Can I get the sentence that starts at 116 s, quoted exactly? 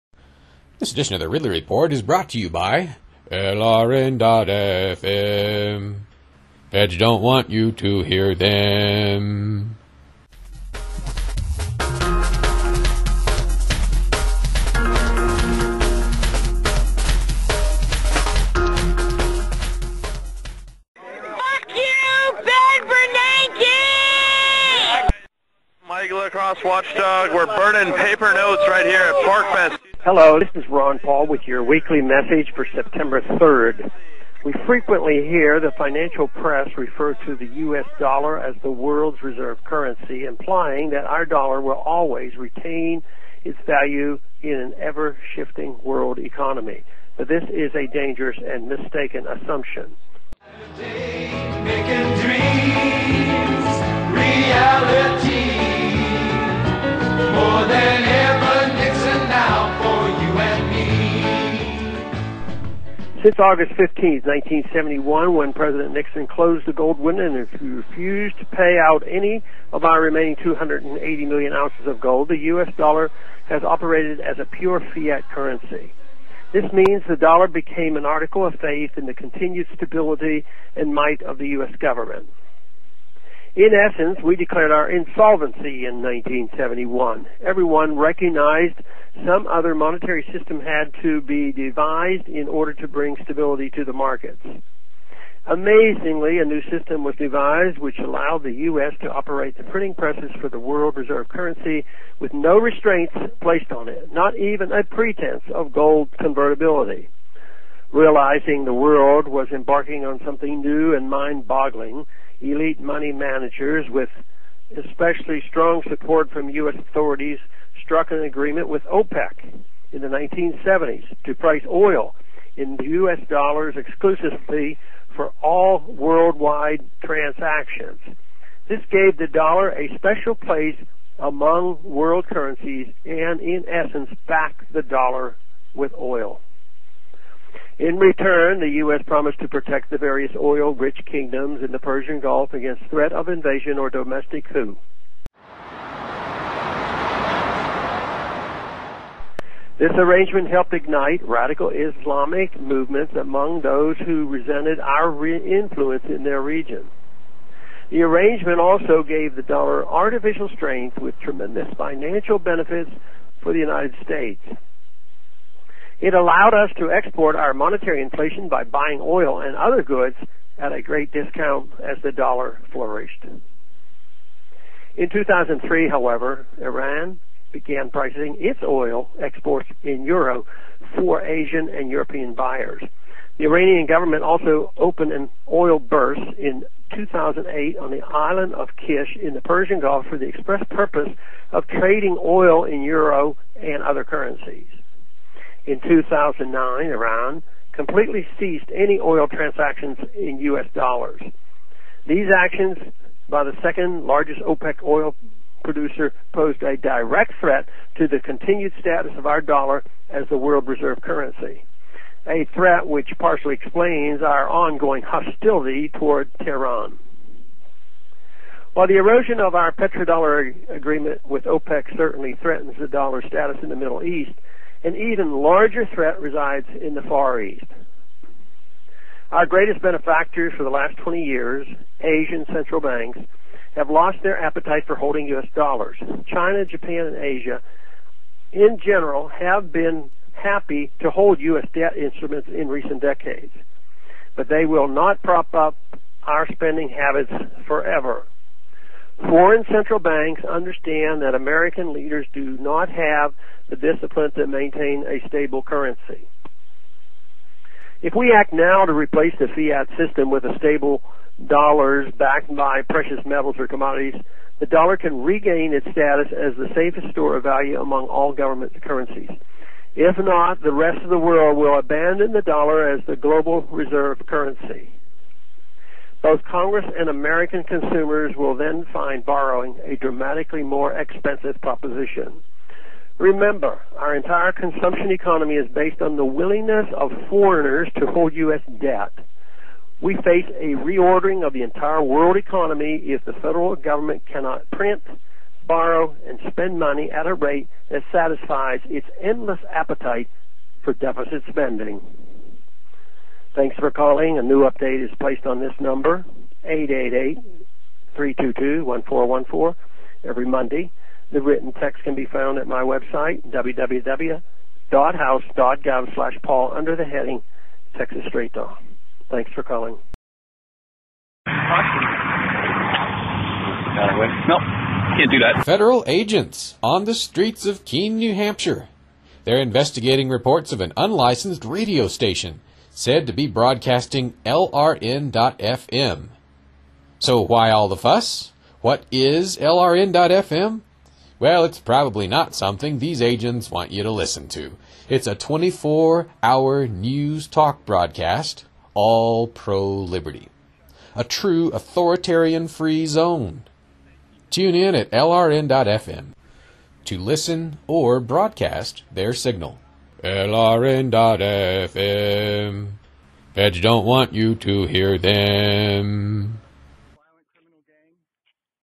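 authorities struck an agreement with OPEC in the 1970s to price oil in U.S.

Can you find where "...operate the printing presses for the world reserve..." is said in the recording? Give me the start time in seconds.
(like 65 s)
99 s.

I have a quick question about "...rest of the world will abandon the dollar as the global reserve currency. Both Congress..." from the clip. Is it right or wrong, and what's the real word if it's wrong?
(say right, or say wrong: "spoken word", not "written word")
right.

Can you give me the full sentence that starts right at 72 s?
dollar has operated as a pure fiat currency.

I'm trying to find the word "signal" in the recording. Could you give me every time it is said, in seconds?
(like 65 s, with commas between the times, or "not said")
359 s.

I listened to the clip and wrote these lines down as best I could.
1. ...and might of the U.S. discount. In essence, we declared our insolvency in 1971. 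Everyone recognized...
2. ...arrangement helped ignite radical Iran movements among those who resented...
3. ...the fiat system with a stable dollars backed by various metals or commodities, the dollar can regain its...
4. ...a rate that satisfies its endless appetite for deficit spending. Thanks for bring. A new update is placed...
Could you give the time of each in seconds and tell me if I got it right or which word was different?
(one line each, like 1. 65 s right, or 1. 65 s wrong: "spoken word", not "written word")
1. 80 s wrong: "government", not "discount"
2. 149 s wrong: "Islamic", not "Iran"
3. 259 s wrong: "precious", not "various"
4. 297 s wrong: "calling", not "bring".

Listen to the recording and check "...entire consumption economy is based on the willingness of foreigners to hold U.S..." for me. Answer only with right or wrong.
right.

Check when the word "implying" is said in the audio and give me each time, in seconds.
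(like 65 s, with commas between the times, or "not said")
40 s.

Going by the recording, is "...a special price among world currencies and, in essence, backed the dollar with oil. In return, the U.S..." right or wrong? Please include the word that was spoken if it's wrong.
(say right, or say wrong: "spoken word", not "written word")
wrong: "place", not "price".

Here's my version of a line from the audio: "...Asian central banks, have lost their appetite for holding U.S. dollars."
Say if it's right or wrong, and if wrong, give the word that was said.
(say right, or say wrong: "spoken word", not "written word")
right.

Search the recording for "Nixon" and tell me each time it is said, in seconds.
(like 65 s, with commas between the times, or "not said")
65 s.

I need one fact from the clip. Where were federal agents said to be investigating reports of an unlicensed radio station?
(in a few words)
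Keene, New Hampshire.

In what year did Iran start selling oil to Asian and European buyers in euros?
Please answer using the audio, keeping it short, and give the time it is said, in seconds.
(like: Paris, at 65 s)
2003, at 175 s.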